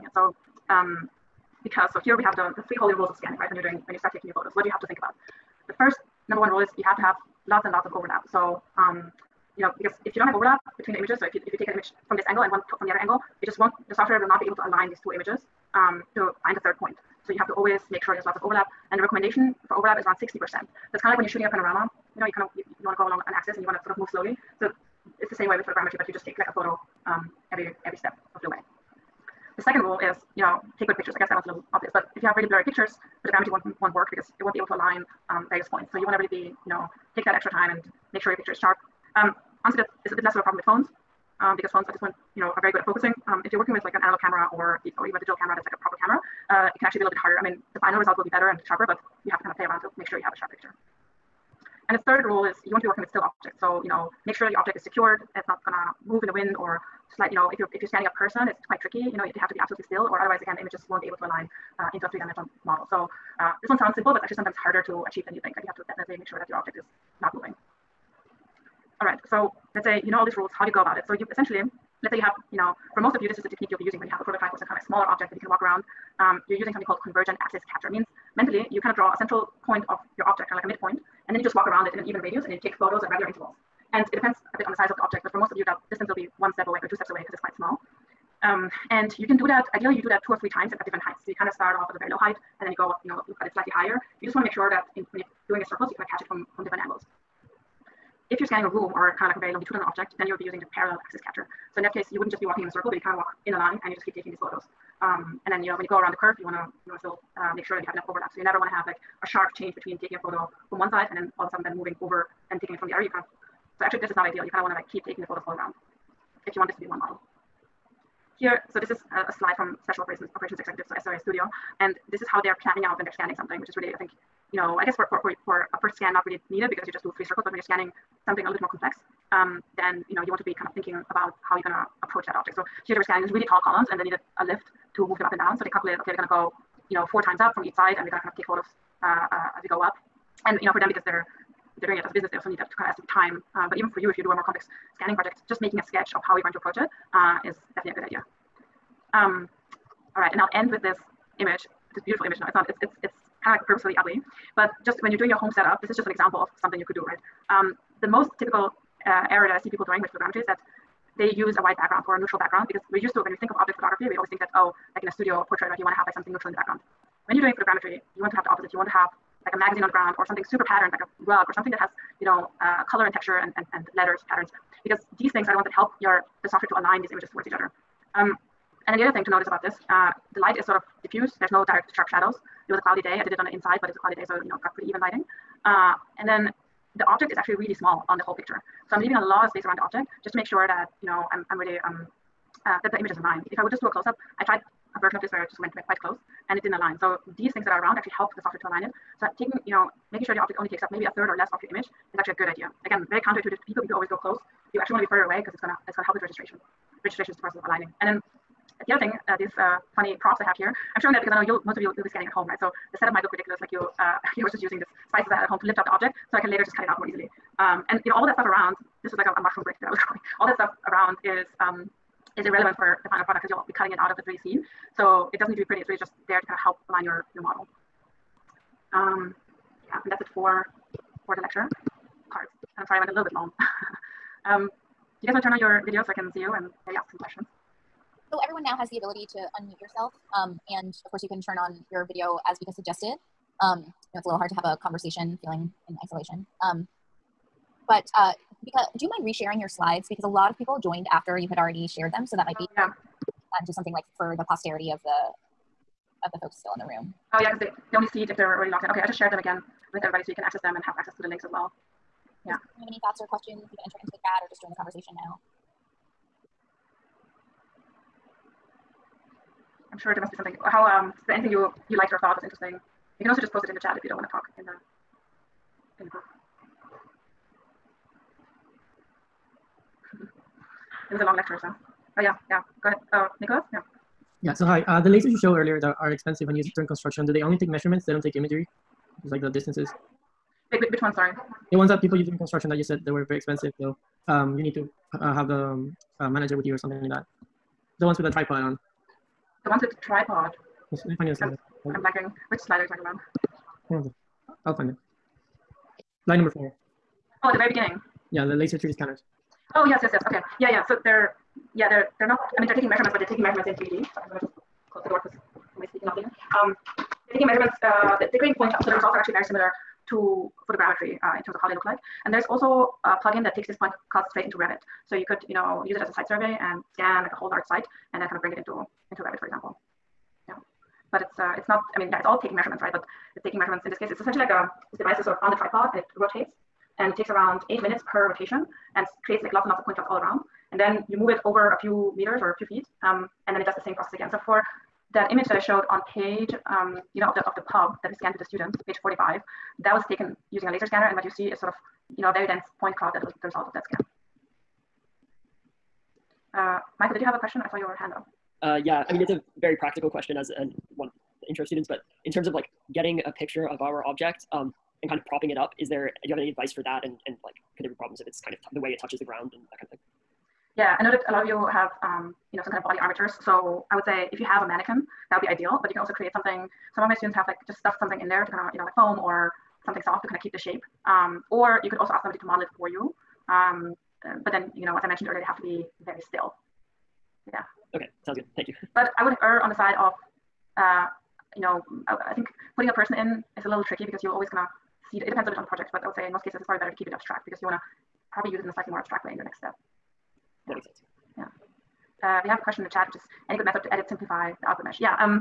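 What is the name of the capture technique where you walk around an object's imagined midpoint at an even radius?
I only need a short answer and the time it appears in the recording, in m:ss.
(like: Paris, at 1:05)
convergent axis capture, at 1:17.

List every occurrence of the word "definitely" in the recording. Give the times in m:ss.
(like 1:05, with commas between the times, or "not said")
1:05, 2:27.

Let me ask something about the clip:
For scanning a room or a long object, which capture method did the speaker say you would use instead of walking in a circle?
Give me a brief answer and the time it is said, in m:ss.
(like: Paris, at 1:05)
parallel axis capture, at 1:40.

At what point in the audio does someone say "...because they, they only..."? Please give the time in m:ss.
4:17.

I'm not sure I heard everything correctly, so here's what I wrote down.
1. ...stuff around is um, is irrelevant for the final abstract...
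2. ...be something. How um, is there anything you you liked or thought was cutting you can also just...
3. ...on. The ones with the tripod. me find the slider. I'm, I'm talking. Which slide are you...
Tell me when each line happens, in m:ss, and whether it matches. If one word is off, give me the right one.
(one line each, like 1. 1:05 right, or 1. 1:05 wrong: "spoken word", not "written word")
1. 3:40 wrong: "product", not "abstract"
2. 4:30 wrong: "interesting", not "cutting"
3. 4:58 wrong: "blanking", not "talking".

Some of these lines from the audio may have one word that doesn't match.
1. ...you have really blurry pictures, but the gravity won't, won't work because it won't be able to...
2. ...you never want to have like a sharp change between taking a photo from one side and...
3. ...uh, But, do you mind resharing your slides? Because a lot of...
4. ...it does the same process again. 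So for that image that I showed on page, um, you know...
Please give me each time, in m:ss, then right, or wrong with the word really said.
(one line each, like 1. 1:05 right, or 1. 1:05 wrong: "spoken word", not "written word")
1. 0:32 right
2. 1:48 right
3. 4:08 wrong: "Bika", not "But"
4. 5:43 right.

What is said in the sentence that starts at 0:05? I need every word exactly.
The first number one rule is you have to have lots and lots of overlap.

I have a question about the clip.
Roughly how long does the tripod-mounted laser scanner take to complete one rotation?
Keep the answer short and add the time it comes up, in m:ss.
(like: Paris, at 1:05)
8 minutes, at 5:37.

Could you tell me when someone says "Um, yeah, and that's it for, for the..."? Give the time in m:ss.
3:48.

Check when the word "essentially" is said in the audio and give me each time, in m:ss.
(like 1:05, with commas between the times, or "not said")
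1:11, 5:34.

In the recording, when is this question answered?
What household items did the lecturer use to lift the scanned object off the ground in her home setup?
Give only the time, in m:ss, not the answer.
3:35.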